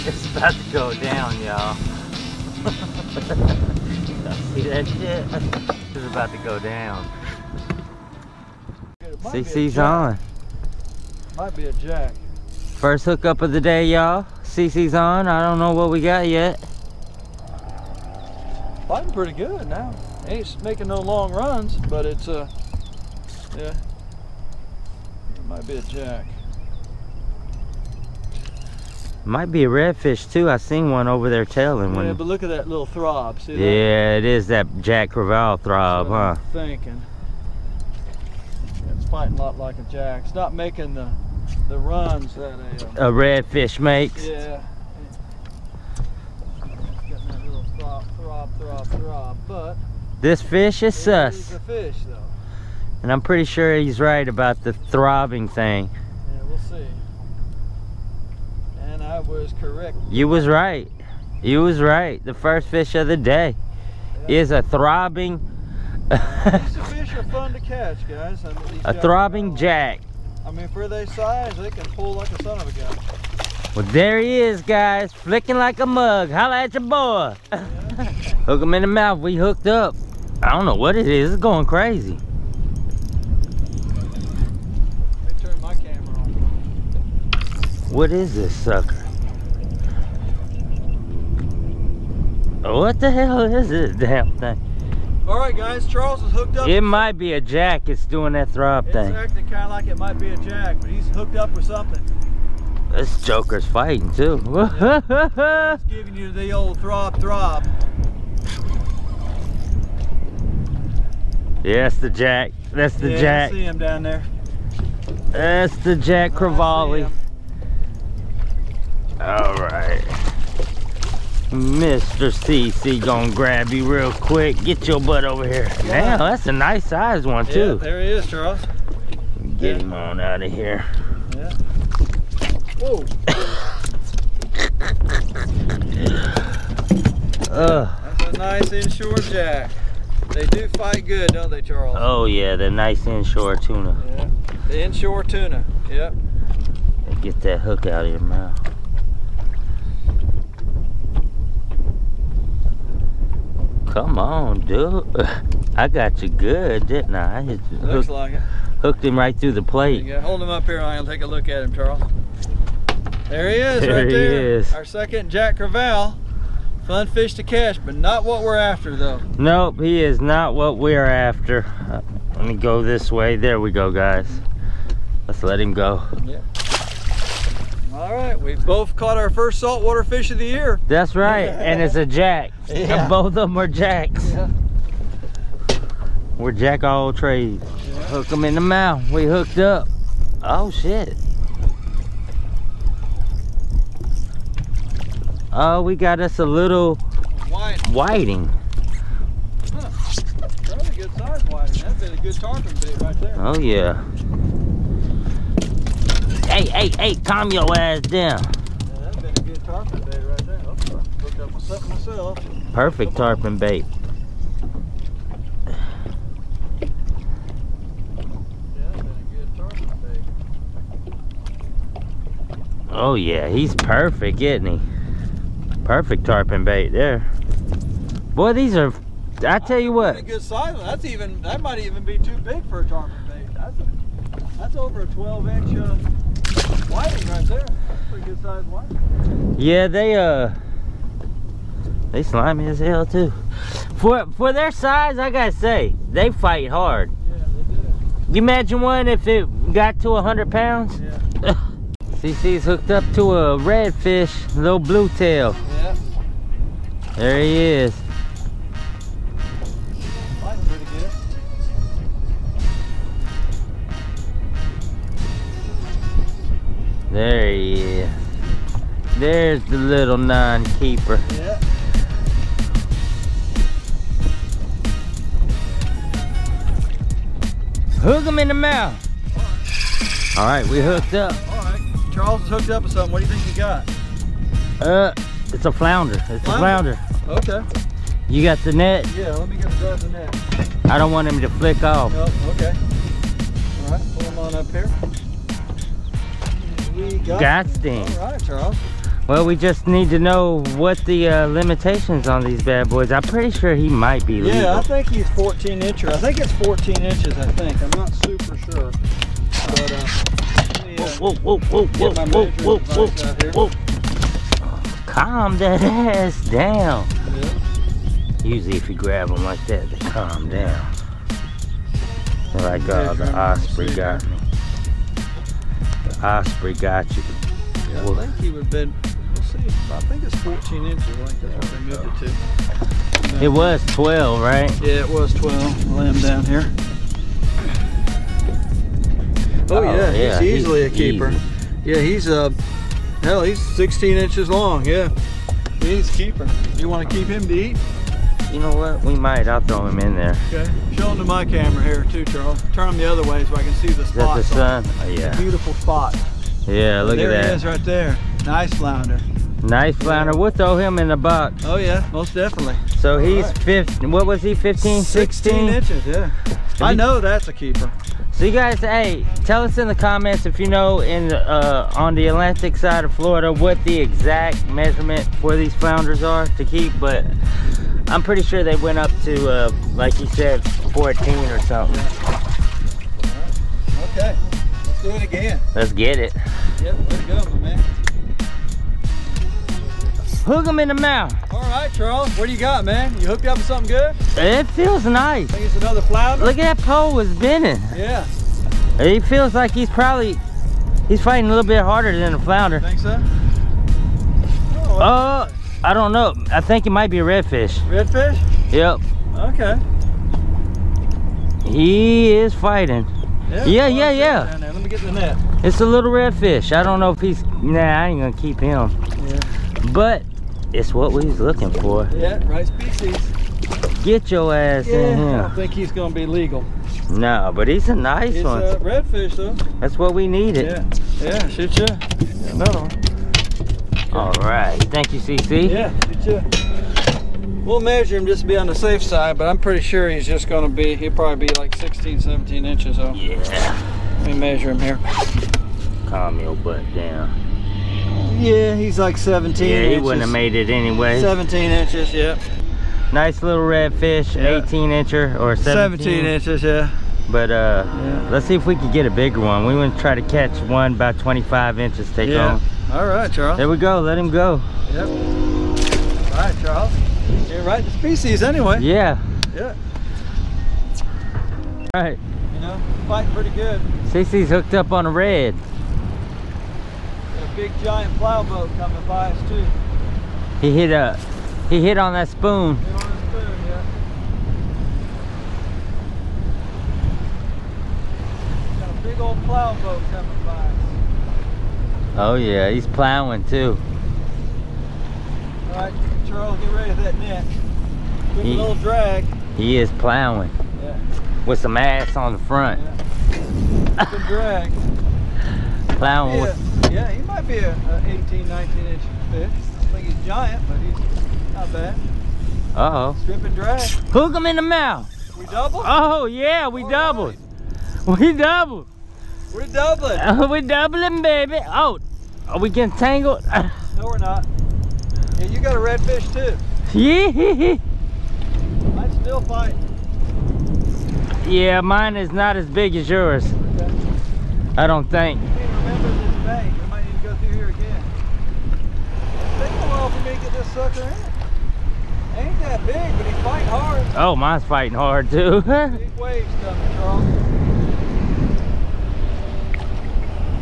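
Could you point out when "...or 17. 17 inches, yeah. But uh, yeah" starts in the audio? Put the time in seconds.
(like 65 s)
455 s.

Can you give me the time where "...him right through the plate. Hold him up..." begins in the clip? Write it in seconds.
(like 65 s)
159 s.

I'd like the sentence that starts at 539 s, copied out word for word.
a while for me to get this sucker in.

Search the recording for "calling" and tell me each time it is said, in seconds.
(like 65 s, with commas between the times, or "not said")
not said.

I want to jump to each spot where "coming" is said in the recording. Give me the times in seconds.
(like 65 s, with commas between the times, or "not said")
478 s, 490 s, 546 s.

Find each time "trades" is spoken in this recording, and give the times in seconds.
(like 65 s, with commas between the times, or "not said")
187 s.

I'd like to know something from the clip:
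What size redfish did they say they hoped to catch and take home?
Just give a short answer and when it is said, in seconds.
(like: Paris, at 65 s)
25 inches, at 461 s.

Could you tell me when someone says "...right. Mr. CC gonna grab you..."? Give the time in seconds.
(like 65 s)
119 s.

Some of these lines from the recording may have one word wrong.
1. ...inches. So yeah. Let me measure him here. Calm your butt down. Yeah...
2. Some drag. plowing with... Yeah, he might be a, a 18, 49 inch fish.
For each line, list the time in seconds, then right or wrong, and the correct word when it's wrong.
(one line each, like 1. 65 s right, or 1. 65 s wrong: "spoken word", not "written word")
1. 442 s right
2. 504 s wrong: "19", not "49".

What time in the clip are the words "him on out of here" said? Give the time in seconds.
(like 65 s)
129 s.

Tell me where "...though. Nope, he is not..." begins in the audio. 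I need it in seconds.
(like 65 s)
168 s.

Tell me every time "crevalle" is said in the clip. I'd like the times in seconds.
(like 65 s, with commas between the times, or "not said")
35 s, 116 s, 165 s.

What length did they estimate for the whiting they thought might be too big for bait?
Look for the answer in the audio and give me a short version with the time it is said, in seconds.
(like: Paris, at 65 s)
over 12 inches, at 234 s.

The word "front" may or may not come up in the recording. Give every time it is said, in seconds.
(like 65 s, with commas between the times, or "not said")
502 s.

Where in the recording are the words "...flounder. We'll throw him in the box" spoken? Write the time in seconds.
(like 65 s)
359 s.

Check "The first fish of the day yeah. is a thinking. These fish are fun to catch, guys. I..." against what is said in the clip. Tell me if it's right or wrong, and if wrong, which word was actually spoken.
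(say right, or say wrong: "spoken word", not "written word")
wrong: "throbbing", not "thinking".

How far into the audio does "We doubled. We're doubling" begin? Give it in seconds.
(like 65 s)
518 s.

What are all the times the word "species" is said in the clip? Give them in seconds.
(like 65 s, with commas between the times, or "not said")
422 s, 467 s.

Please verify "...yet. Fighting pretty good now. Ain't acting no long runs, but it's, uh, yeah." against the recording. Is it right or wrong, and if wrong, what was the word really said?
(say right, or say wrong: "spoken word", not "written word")
wrong: "making", not "acting".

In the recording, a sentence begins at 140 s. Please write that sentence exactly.
They do fight good, don't they, Charles?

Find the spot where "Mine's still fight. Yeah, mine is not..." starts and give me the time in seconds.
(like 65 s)
528 s.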